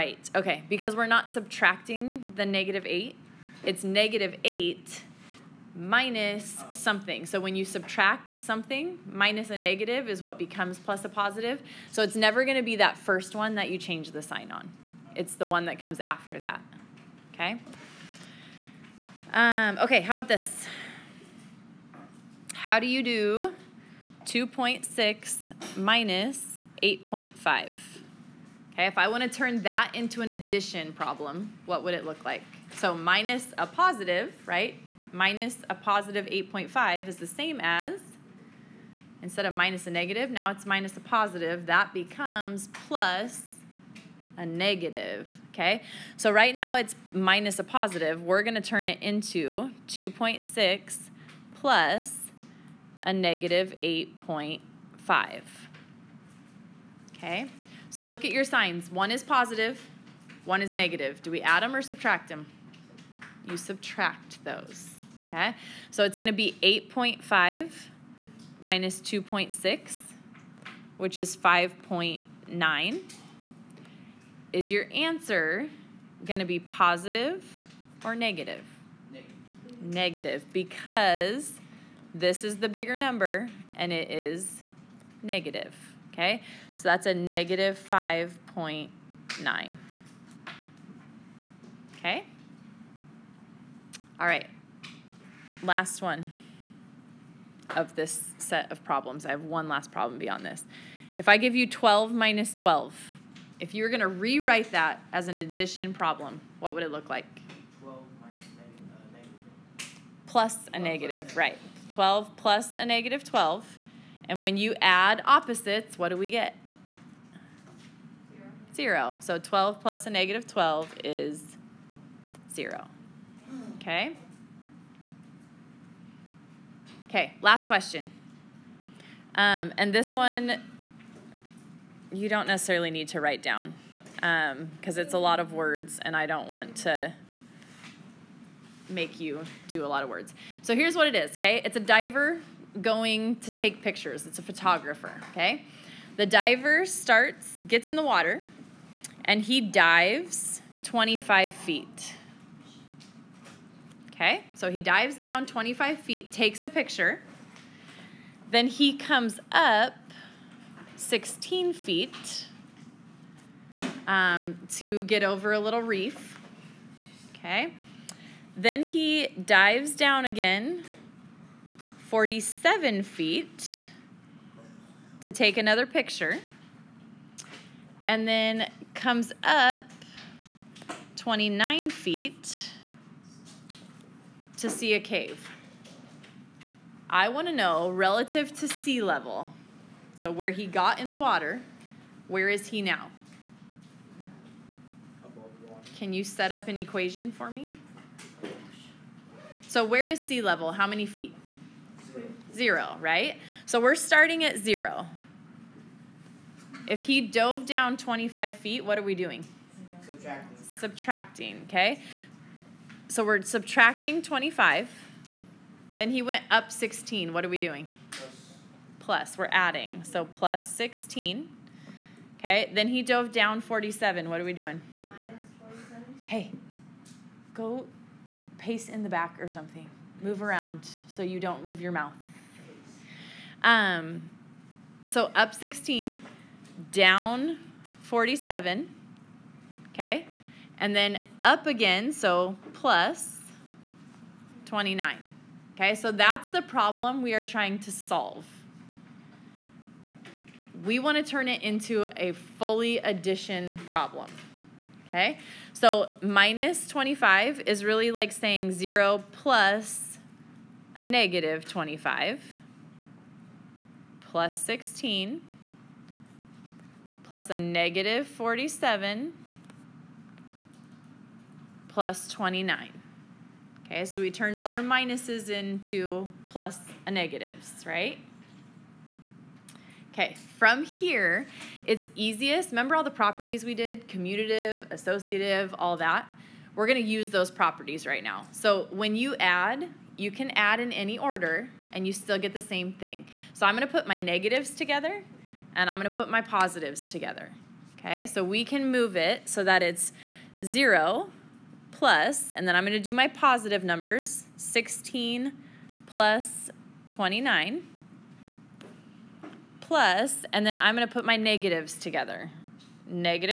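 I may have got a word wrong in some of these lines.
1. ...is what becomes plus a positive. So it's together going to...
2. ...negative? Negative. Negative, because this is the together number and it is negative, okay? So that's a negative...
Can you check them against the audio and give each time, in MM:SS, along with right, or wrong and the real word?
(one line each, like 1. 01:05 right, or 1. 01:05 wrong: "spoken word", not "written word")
1. 00:10 wrong: "never", not "together"
2. 01:18 wrong: "bigger", not "together".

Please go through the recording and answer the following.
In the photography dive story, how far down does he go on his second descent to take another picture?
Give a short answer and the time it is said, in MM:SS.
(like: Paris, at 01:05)
47 feet, at 02:51.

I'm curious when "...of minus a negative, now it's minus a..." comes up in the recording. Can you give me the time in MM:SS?
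00:39.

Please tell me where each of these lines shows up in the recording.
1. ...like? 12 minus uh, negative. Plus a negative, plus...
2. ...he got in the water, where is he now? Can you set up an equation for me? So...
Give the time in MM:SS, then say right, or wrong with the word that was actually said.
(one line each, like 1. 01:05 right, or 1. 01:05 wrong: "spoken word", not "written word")
1. 01:47 right
2. 03:10 right.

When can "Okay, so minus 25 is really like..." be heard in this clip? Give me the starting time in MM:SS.
04:15.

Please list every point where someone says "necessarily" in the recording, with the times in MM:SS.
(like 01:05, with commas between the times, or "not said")
02:12.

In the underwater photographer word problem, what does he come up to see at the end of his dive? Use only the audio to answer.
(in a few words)
a cave.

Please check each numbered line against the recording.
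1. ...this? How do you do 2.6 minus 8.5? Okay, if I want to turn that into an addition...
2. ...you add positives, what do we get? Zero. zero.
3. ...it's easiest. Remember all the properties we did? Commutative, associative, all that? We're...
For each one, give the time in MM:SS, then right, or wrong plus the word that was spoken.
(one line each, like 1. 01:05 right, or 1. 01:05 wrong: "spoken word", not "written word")
1. 00:20 right
2. 01:54 wrong: "opposites", not "positives"
3. 04:41 right.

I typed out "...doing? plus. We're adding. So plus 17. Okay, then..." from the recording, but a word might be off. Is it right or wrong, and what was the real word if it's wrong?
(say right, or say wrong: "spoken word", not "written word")
wrong: "16", not "17".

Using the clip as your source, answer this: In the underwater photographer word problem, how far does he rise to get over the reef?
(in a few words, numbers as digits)
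16 feet.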